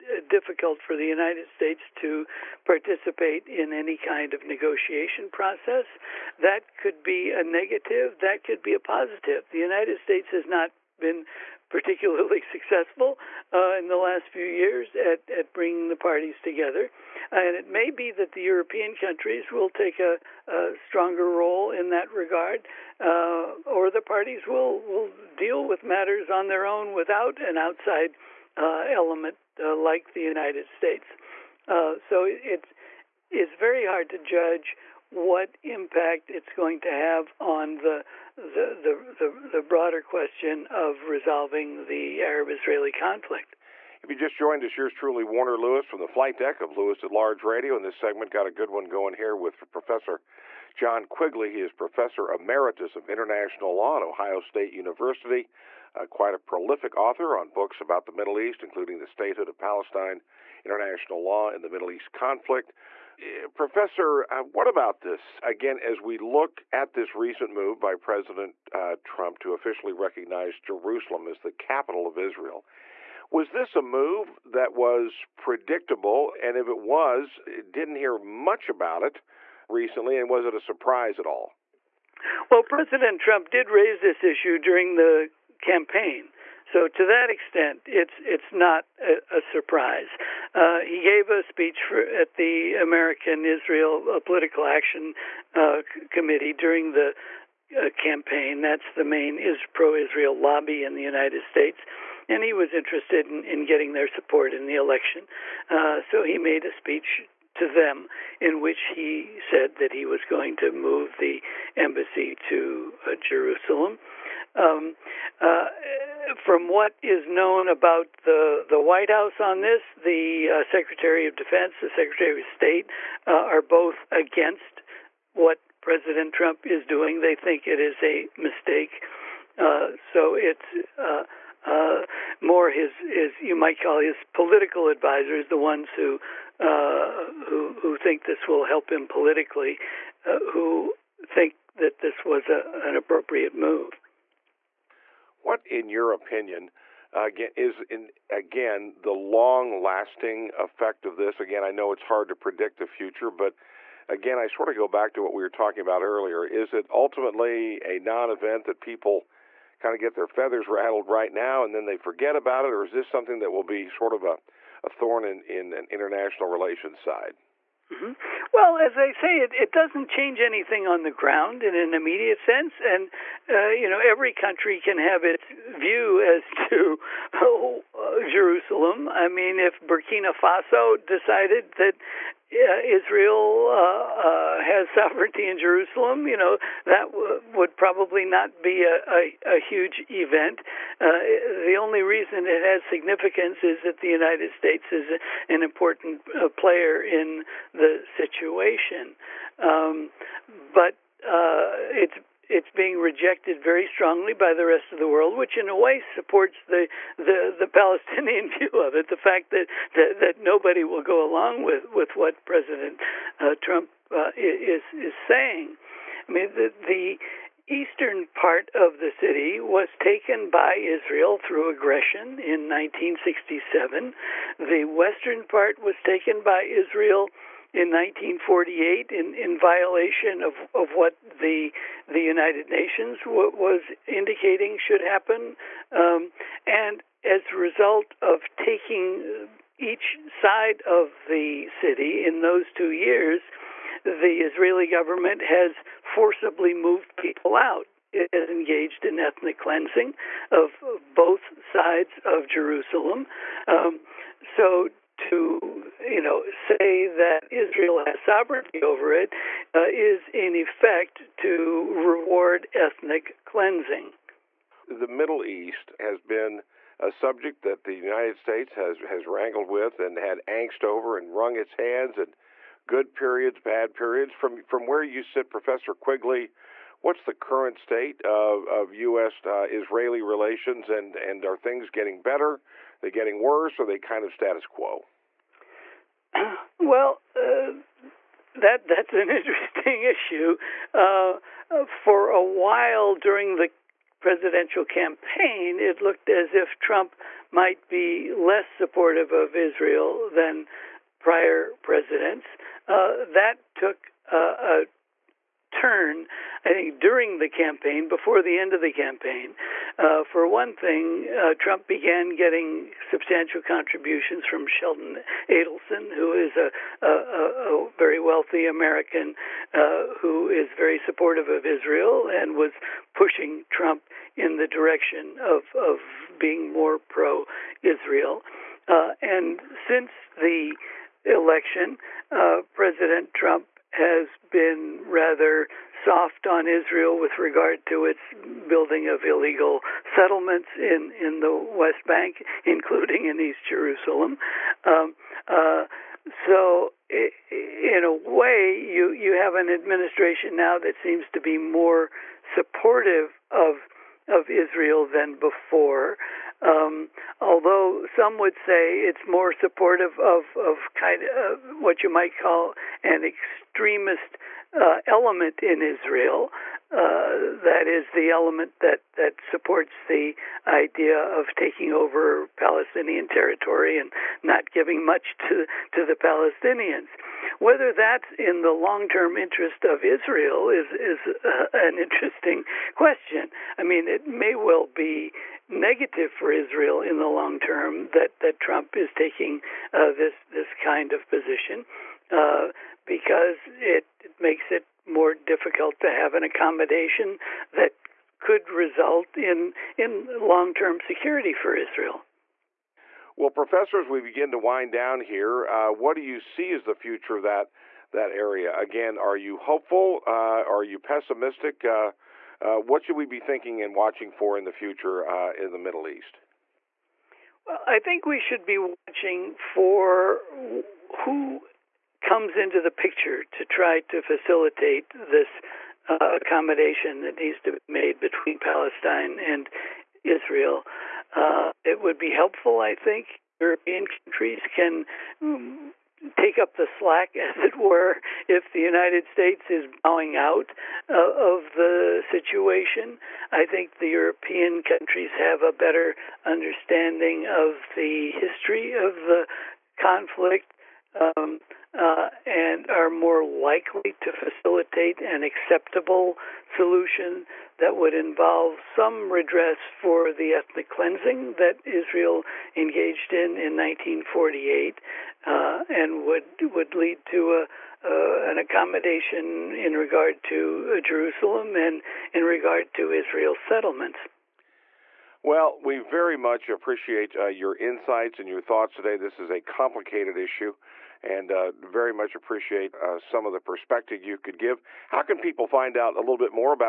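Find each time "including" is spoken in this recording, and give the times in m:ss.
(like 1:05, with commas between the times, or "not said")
0:58, 5:42.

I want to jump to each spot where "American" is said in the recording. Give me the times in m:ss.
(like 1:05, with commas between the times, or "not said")
1:32, 5:18.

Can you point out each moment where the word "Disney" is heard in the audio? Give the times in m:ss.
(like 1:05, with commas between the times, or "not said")
not said.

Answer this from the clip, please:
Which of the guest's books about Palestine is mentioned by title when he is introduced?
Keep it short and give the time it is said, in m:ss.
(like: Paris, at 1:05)
The Statehood of Palestine, at 0:58.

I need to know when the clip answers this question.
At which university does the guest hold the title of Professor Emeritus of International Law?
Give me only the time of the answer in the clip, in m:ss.
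0:54.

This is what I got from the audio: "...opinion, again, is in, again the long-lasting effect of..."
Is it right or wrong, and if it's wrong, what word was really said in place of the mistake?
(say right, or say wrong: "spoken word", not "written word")
right.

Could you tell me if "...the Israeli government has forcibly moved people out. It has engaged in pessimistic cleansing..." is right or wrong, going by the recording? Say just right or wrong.
wrong.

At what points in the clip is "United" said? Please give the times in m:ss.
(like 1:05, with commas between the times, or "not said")
0:01, 0:09, 0:30, 1:41, 3:14, 3:52, 4:27, 7:18.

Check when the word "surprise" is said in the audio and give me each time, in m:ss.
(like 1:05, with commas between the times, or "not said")
1:20, 1:29.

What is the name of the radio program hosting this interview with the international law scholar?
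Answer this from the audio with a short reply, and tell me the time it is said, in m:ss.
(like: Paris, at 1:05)
Lewis at Large Radio, at 0:46.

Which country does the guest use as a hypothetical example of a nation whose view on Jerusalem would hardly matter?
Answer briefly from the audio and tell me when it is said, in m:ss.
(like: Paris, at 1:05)
Burkina Faso, at 2:59.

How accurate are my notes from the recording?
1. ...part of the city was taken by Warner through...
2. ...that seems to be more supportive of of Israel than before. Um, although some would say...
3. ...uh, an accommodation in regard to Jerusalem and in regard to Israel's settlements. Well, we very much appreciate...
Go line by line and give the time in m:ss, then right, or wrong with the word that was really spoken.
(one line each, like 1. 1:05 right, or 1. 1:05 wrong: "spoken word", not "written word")
1. 3:38 wrong: "Israel", not "Warner"
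2. 5:50 right
3. 7:47 right.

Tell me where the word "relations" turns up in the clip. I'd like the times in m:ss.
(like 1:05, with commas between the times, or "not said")
2:46, 4:40.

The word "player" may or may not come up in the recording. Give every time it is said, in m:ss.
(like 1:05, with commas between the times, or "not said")
3:16.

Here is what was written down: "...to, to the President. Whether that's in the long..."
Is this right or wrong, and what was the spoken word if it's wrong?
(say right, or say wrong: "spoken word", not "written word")
wrong: "Palestinians", not "President".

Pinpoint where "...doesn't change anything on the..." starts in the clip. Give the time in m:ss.
2:49.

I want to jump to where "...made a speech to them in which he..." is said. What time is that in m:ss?
1:46.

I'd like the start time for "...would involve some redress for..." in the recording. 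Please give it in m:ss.
7:37.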